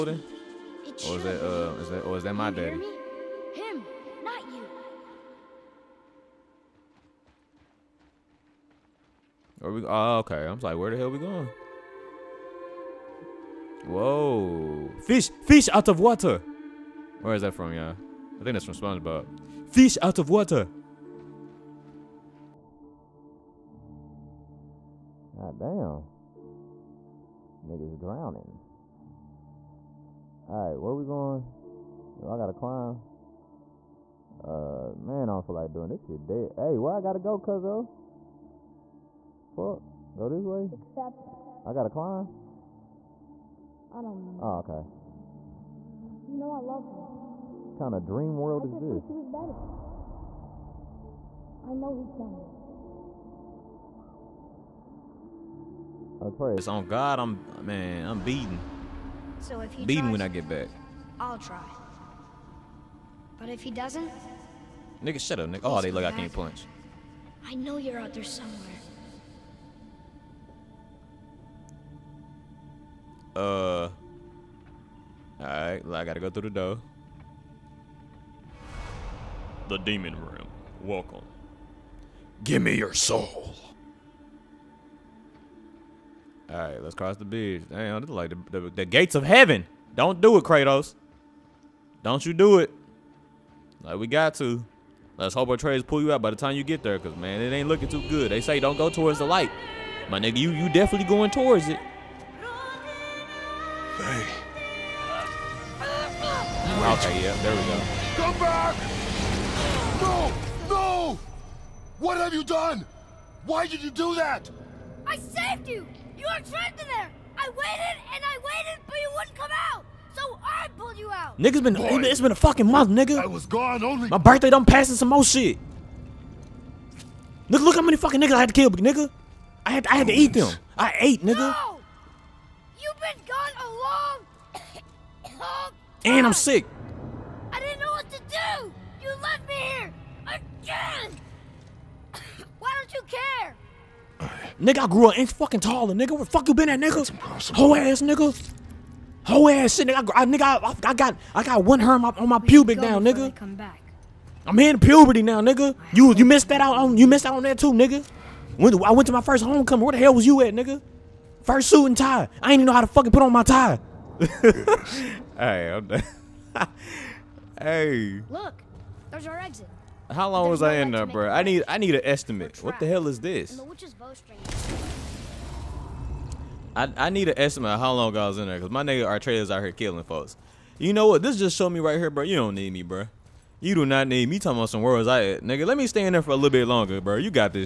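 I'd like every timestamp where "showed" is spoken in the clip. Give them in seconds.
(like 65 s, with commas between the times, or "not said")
181 s.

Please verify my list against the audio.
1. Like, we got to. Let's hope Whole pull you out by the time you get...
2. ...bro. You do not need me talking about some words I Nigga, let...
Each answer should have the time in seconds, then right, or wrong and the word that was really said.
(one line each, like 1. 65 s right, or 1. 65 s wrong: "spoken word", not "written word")
1. 93 s wrong: "Atreus", not "Whole"
2. 182 s right.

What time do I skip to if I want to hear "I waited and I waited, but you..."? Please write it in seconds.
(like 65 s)
117 s.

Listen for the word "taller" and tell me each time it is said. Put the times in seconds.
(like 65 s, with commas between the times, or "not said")
145 s.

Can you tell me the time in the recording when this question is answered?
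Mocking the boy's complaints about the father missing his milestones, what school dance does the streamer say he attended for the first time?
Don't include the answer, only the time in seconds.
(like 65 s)
159 s.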